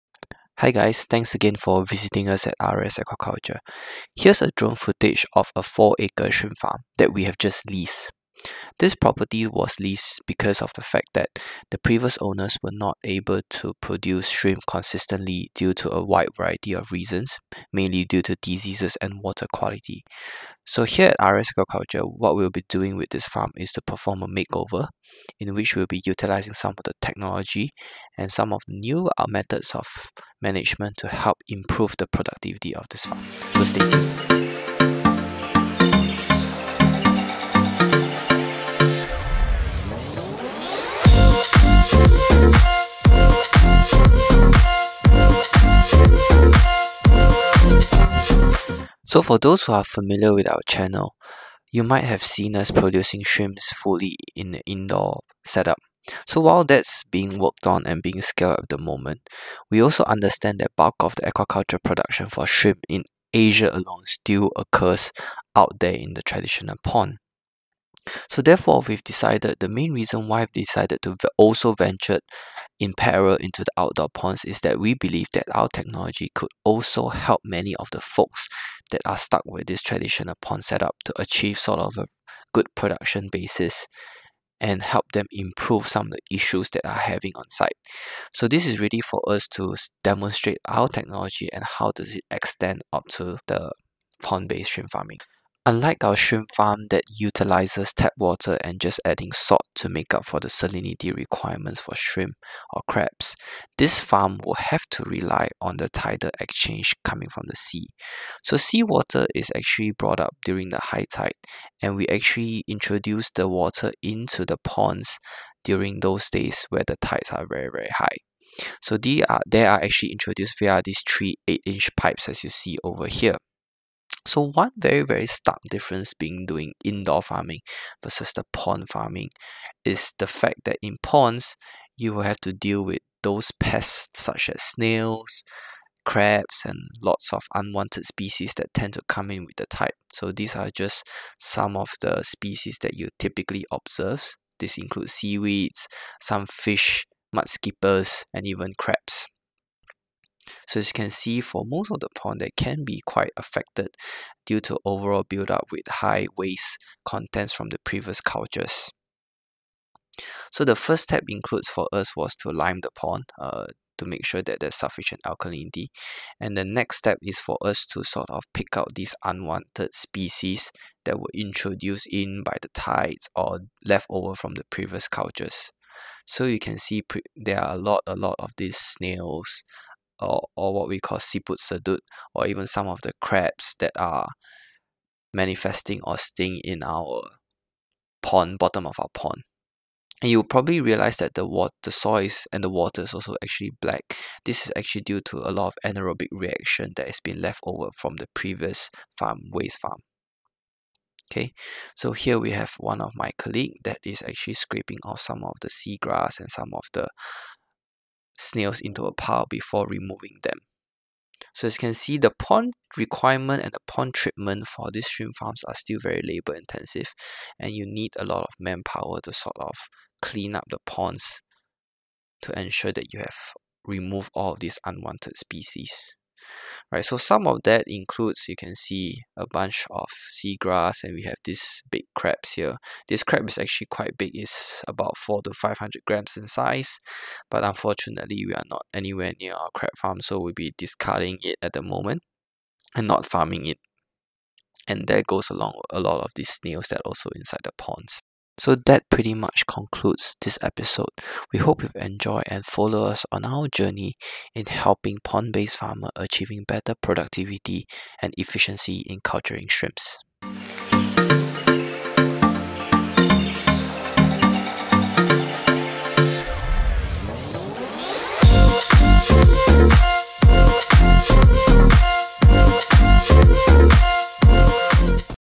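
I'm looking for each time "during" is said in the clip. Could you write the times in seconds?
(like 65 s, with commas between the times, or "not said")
110 s, 115 s.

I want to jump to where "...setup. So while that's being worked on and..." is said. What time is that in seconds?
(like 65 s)
55 s.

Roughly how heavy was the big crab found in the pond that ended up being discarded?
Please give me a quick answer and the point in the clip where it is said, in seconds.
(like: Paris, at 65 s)
400 to 500 grams, at 235 s.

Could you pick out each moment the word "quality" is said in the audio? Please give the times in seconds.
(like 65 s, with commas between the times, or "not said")
19 s.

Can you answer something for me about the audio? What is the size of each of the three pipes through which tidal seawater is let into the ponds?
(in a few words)
8-inch.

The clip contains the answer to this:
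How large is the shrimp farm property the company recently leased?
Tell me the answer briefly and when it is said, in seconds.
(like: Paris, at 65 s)
4 acres, at 5 s.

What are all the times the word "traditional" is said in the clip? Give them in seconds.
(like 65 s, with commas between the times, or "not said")
66 s, 79 s.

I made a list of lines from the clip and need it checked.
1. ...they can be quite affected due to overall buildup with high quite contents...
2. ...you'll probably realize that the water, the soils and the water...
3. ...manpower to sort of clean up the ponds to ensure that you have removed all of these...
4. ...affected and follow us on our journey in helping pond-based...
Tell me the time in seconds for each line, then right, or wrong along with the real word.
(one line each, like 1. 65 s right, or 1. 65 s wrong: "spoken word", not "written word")
1. 152 s wrong: "waste", not "quite"
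2. 190 s right
3. 218 s right
4. 251 s wrong: "enjoyed", not "affected".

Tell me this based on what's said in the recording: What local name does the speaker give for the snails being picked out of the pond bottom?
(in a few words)
siput sedut.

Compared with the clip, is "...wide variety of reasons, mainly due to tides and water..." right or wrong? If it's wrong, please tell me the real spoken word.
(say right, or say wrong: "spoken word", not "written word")
wrong: "diseases", not "tides".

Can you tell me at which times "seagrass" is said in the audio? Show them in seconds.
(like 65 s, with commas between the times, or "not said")
205 s, 230 s.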